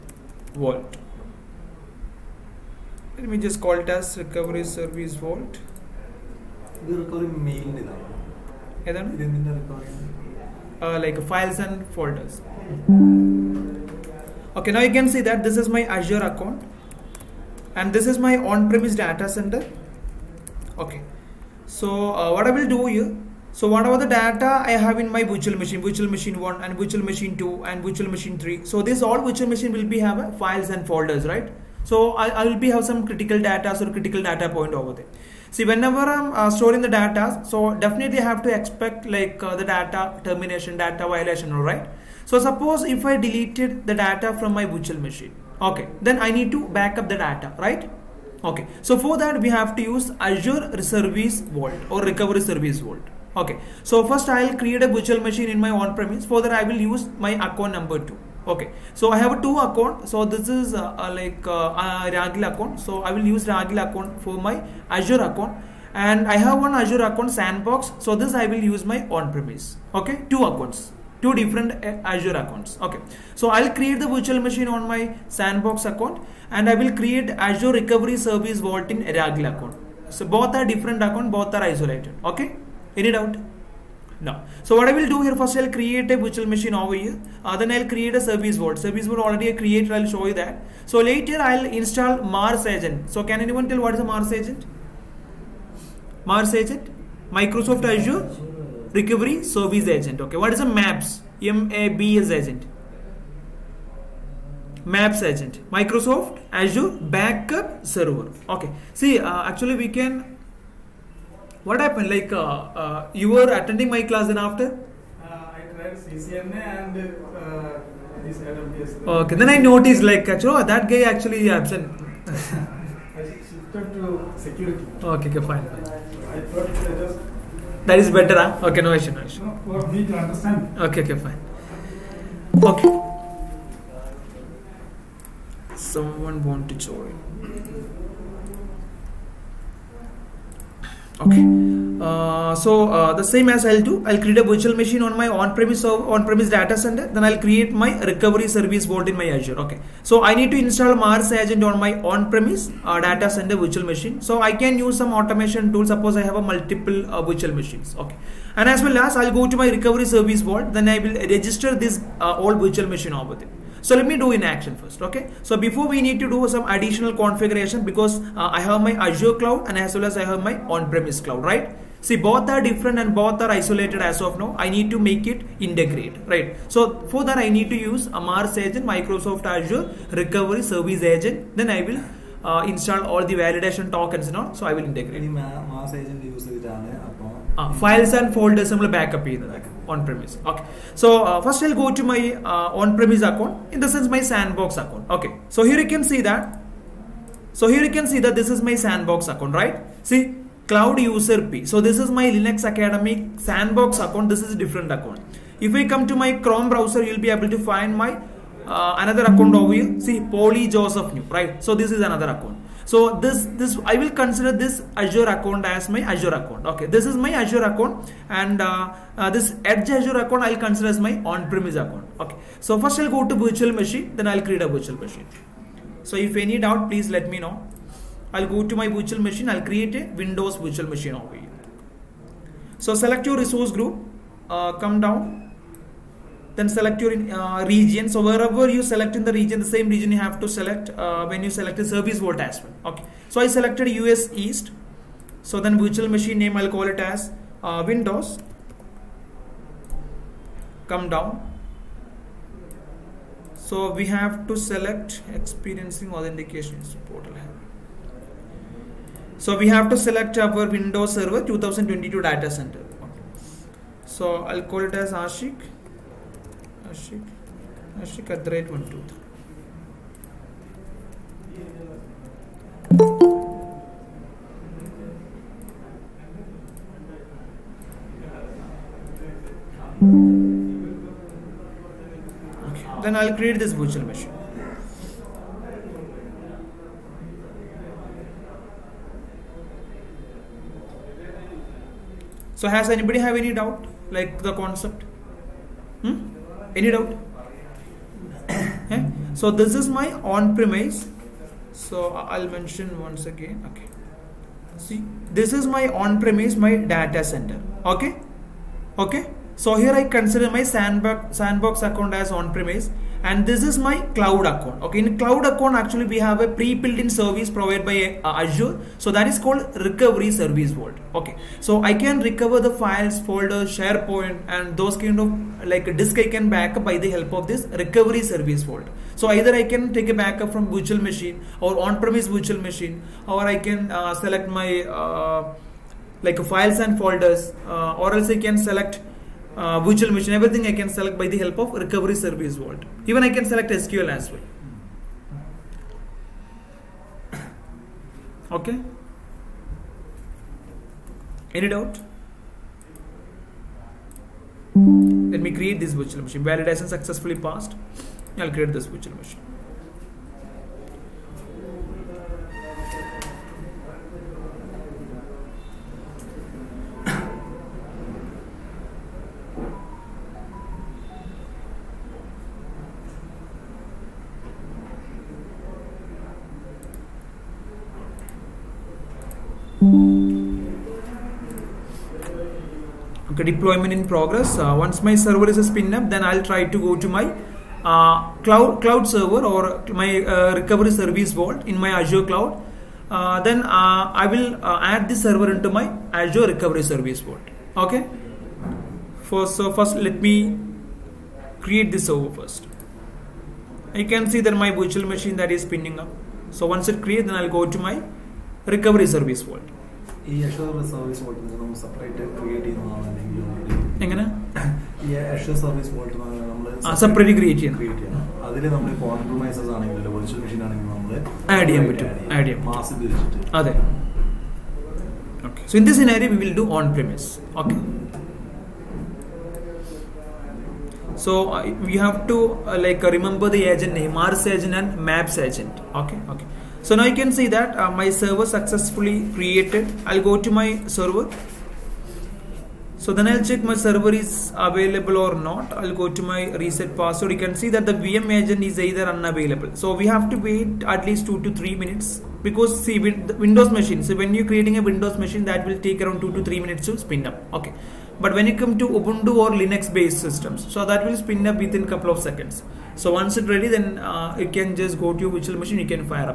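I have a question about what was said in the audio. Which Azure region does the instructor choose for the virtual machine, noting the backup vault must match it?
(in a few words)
US East.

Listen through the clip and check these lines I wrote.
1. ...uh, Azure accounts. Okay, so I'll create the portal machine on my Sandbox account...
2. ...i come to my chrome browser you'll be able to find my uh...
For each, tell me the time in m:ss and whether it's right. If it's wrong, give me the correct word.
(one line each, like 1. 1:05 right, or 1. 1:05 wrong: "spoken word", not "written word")
1. 1:11 wrong: "virtual", not "portal"
2. 3:25 right.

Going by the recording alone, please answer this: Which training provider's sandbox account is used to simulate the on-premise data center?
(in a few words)
Linux Academy.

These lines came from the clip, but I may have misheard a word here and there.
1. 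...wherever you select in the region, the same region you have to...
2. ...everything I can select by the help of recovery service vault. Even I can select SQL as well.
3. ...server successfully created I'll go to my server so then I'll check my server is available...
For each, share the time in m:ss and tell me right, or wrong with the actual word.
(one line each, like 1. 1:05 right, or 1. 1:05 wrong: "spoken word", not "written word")
1. 3:58 right
2. 5:40 right
3. 7:18 right.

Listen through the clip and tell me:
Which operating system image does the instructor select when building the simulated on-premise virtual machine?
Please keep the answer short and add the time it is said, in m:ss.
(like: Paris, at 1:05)
Windows Server 2022 Datacenter, at 4:20.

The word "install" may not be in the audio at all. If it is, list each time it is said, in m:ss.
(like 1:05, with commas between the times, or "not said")
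1:31, 2:30, 3:02.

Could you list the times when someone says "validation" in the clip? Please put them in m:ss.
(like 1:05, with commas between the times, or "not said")
3:03, 5:56.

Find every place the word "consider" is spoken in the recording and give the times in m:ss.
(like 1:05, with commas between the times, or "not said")
3:34, 3:40, 5:10.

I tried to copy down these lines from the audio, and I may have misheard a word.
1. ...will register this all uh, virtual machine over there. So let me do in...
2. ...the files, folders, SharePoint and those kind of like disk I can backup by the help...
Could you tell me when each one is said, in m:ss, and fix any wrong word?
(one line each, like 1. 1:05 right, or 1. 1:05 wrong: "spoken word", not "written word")
1. 2:40 right
2. 5:22 right.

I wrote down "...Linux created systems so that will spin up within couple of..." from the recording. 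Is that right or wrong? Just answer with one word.
wrong.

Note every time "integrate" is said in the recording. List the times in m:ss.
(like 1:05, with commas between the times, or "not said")
2:55, 3:04.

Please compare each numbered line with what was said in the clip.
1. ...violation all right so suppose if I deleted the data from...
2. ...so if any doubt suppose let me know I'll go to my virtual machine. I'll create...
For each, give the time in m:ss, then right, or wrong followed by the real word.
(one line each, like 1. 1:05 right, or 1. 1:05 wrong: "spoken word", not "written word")
1. 0:41 right
2. 3:46 wrong: "please", not "suppose".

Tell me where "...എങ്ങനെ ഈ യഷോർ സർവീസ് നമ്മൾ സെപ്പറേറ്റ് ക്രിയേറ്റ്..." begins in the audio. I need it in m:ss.
6:54.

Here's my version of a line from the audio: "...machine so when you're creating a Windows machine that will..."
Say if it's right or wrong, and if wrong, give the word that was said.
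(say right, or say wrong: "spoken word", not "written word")
right.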